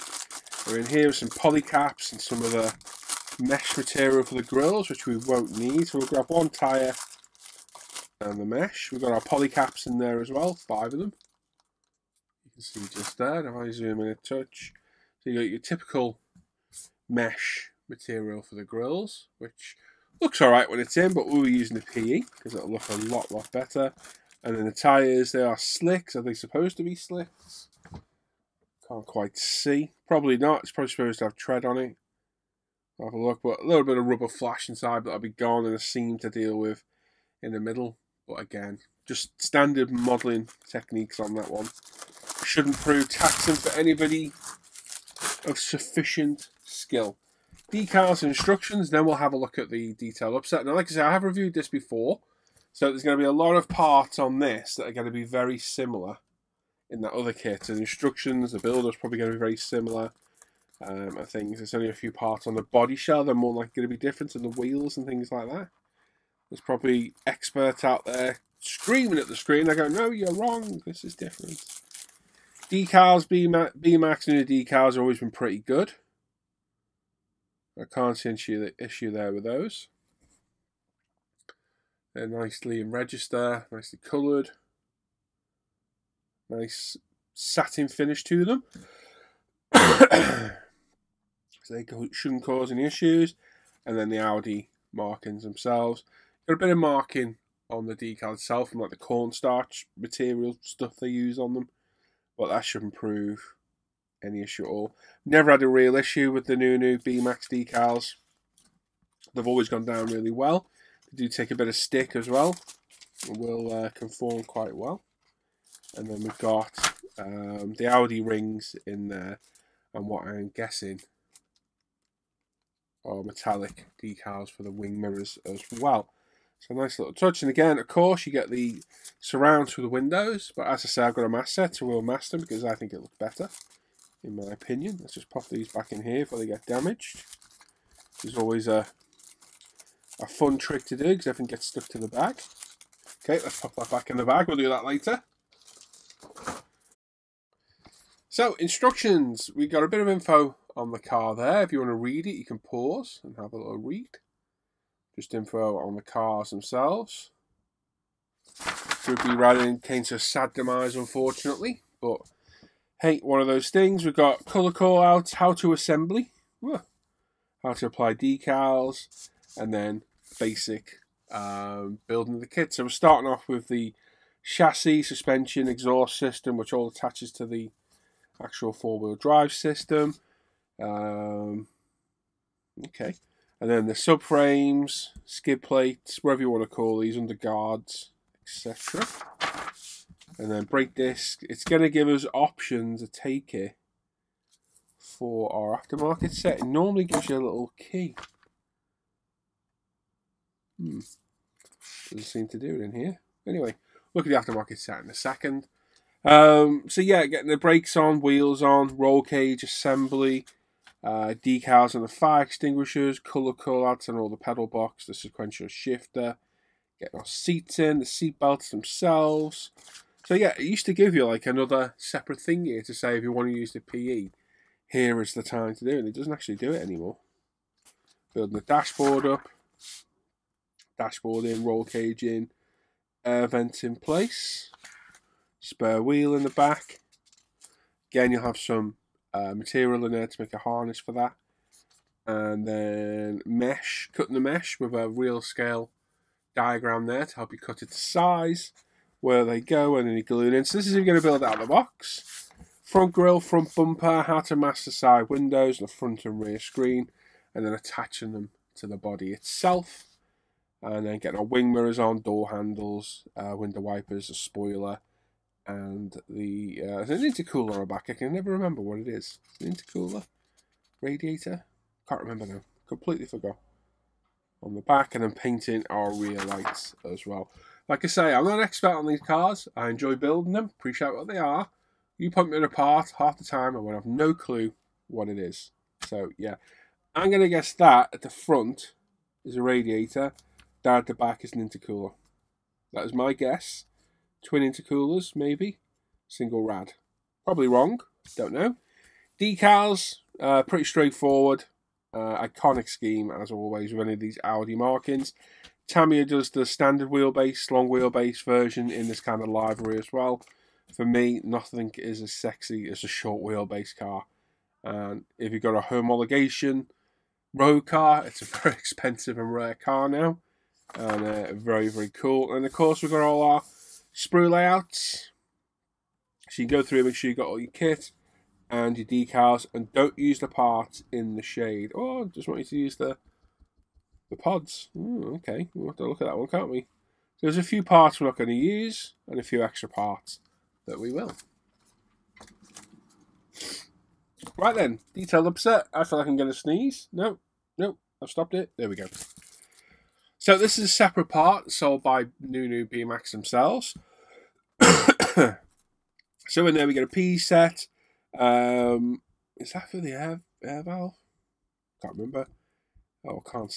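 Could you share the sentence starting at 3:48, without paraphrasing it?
Building the dashboard up dashboard in, roll cage in, air vent in place, spare wheel in the back.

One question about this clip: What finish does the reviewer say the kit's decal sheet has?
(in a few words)
Satin.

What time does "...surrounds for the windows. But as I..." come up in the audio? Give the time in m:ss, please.
2:09.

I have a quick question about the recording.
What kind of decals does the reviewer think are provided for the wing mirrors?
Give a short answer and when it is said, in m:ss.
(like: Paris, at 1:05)
Metallic decals, at 2:03.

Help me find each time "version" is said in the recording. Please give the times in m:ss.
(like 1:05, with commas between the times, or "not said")
5:08.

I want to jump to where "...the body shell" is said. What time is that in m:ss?
1:02.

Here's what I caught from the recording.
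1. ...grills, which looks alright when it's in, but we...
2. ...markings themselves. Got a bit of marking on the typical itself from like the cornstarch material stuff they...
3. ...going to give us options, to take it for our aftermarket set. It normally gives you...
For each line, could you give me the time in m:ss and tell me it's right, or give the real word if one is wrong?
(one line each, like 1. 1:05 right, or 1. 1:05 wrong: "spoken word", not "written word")
1. 0:18 right
2. 1:34 wrong: "decal", not "typical"
3. 3:11 right.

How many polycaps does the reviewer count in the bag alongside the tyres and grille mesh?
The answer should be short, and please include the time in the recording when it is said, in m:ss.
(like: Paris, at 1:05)
5, at 0:10.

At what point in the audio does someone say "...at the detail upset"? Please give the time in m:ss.
0:49.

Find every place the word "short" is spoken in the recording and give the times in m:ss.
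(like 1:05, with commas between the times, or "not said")
5:13.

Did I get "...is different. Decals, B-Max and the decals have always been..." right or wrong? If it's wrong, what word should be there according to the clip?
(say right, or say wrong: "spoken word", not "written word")
right.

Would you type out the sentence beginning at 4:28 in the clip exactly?
I can never remember what it is.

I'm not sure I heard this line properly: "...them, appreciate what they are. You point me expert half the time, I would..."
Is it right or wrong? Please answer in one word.
wrong.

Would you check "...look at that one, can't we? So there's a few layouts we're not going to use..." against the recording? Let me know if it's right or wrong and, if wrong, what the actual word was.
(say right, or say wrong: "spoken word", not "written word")
wrong: "parts", not "layouts".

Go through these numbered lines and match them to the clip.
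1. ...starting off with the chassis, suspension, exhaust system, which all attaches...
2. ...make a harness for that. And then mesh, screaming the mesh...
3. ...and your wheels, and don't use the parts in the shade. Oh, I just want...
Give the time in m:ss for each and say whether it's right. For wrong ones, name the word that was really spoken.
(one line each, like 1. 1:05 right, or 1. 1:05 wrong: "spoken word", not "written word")
1. 2:52 right
2. 4:00 wrong: "cutting", not "screaming"
3. 5:28 wrong: "decals", not "wheels".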